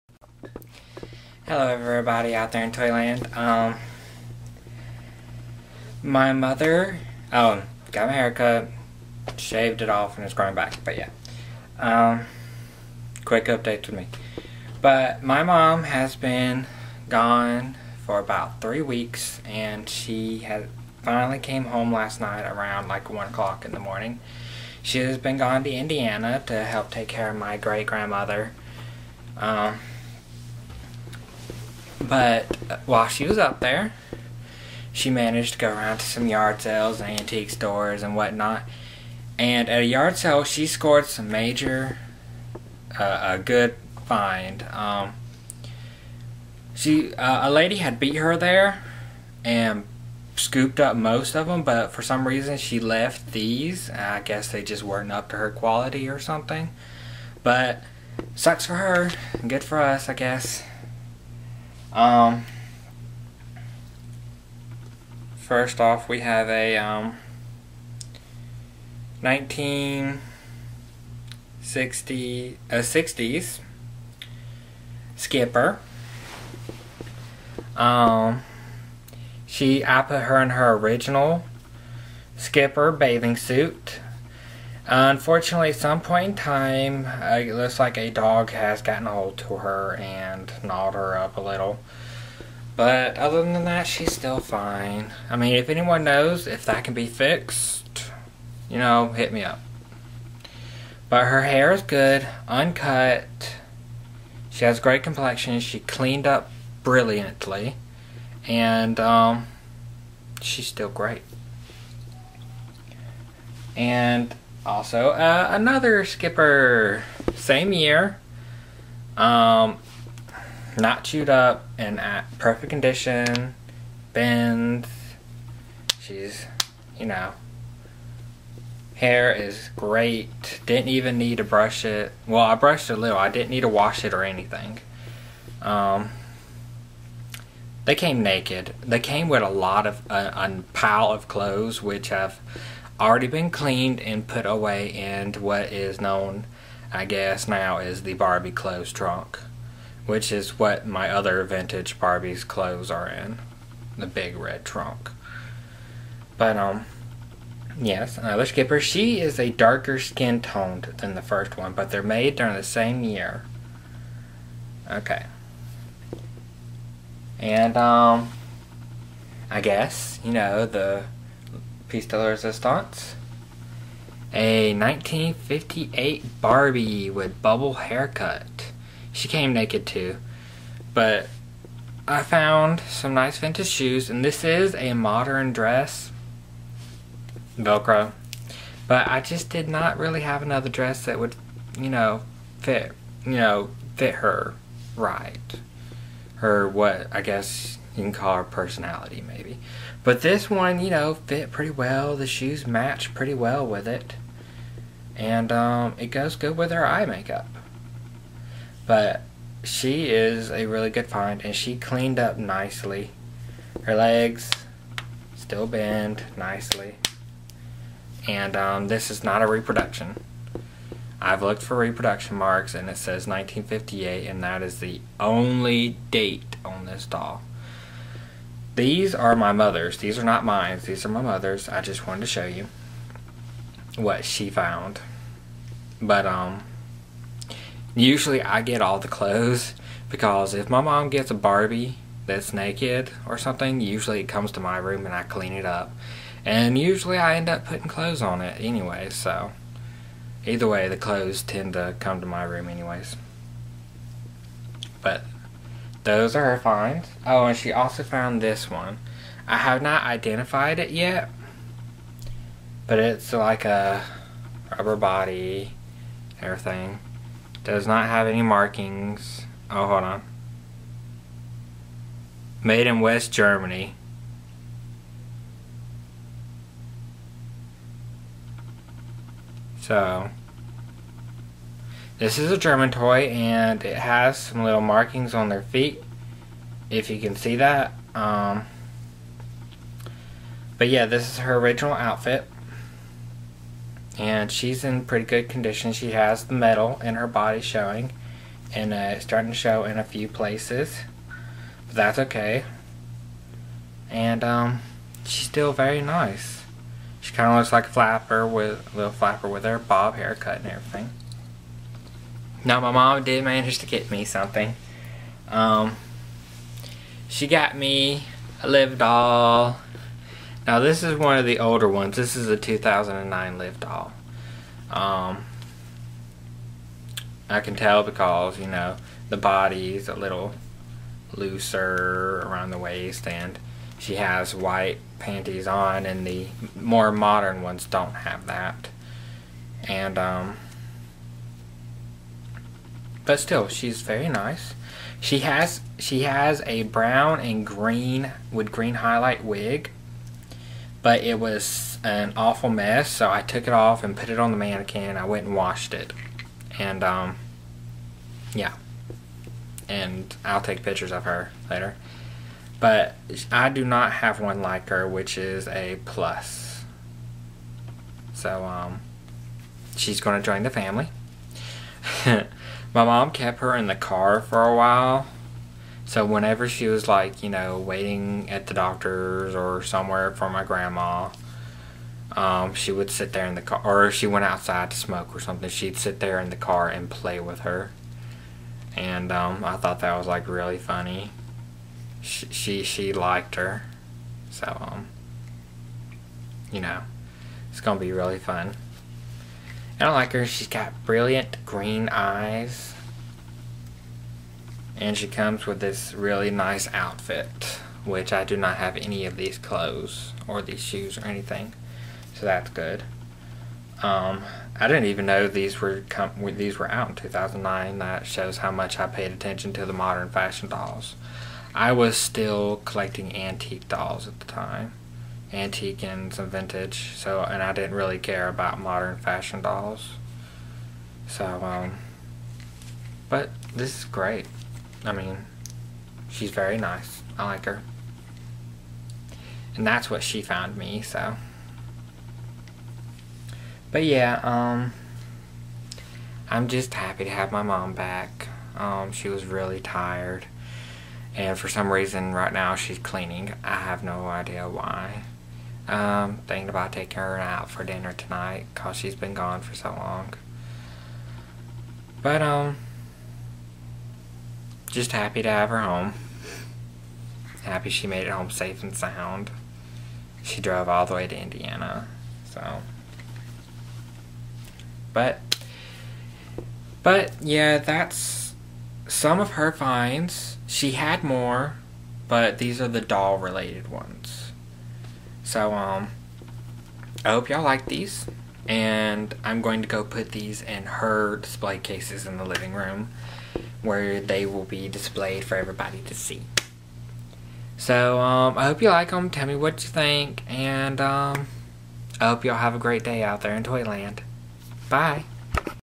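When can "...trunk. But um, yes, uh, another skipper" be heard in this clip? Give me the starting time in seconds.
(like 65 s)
154 s.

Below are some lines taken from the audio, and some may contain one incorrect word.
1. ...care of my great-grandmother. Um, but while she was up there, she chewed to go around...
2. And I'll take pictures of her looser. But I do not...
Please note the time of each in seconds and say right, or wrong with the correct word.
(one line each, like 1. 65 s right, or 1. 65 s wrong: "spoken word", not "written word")
1. 27 s wrong: "managed", not "chewed"
2. 359 s wrong: "later", not "looser".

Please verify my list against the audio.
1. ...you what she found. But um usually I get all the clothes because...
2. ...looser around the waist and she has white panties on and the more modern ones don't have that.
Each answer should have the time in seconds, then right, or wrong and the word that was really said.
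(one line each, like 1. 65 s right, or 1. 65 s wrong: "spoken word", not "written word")
1. 232 s right
2. 331 s right.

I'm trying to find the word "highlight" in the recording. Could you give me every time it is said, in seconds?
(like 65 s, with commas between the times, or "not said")
348 s.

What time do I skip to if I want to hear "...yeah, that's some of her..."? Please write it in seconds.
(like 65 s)
477 s.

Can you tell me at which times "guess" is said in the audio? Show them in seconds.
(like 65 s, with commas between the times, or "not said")
54 s, 60 s, 147 s, 169 s, 197 s.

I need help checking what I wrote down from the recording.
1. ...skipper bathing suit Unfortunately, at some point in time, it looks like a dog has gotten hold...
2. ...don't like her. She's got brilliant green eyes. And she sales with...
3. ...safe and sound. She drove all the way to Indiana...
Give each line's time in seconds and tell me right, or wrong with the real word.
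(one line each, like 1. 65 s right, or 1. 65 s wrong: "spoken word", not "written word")
1. 82 s right
2. 400 s wrong: "comes", not "sales"
3. 468 s right.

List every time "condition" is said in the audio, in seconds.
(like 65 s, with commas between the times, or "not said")
122 s, 295 s.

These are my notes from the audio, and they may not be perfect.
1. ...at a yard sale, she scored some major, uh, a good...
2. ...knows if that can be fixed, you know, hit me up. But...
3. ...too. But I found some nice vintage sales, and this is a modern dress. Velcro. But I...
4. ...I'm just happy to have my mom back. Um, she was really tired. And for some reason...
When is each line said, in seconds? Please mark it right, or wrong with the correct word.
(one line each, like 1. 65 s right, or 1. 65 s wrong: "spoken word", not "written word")
1. 39 s right
2. 96 s right
3. 179 s wrong: "shoes", not "sales"
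4. 446 s right.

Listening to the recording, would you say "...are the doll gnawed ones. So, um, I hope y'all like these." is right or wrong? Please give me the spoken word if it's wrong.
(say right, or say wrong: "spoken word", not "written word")
wrong: "related", not "gnawed".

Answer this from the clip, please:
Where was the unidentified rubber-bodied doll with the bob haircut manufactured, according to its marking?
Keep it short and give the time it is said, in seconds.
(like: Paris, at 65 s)
West Germany, at 272 s.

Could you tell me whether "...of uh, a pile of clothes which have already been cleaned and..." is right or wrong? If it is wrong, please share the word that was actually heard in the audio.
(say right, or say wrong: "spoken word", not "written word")
right.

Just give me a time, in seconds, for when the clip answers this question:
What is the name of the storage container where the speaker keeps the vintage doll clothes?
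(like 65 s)
148 s.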